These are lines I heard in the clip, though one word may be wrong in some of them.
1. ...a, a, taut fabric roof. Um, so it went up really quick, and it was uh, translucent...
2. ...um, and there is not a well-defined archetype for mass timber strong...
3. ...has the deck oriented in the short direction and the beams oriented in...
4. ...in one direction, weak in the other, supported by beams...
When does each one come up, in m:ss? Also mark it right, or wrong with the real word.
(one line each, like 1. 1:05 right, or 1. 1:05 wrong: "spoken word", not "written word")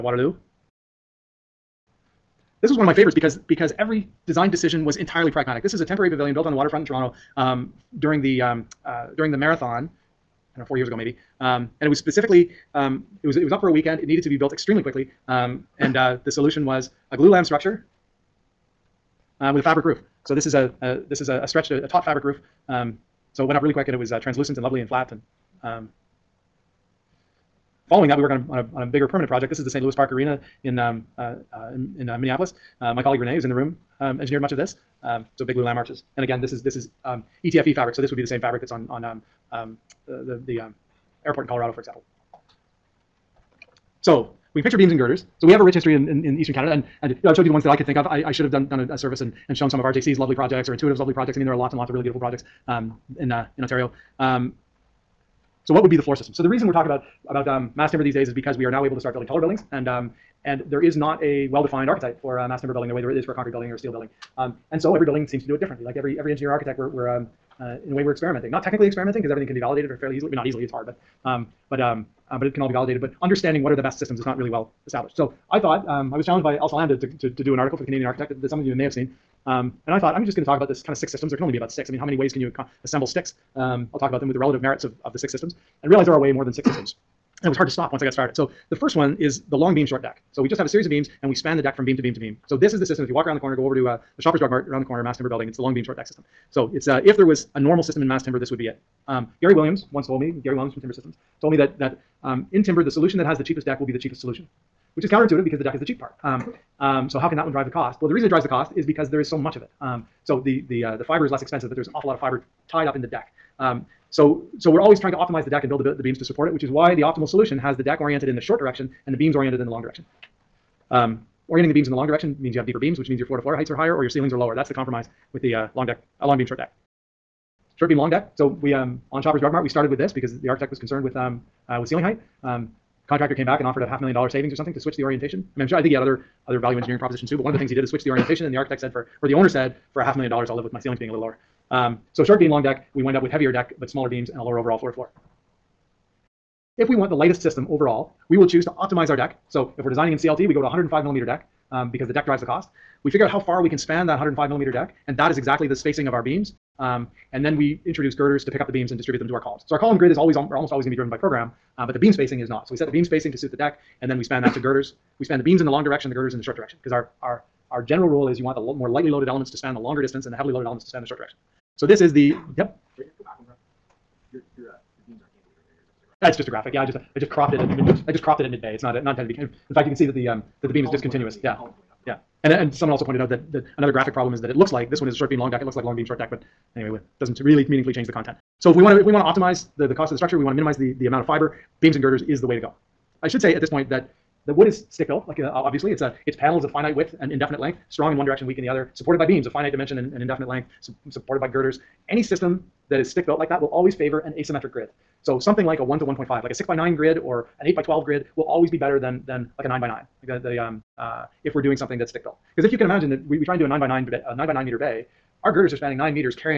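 1. 0:21 right
2. 0:59 wrong: "building", not "strong"
3. 1:57 right
4. 3:18 right.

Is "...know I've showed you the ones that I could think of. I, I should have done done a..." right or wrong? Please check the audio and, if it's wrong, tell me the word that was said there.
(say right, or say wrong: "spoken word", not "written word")
right.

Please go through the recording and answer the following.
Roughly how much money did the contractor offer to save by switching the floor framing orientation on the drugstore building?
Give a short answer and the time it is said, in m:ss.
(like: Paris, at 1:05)
half million dollars, at 2:13.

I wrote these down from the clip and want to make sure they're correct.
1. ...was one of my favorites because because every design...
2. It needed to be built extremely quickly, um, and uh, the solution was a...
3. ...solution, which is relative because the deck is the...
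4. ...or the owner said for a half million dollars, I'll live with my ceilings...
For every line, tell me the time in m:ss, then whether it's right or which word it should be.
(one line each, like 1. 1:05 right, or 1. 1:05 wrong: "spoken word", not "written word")
1. 0:02 right
2. 0:13 right
3. 1:44 wrong: "counterintuitive", not "relative"
4. 2:19 right.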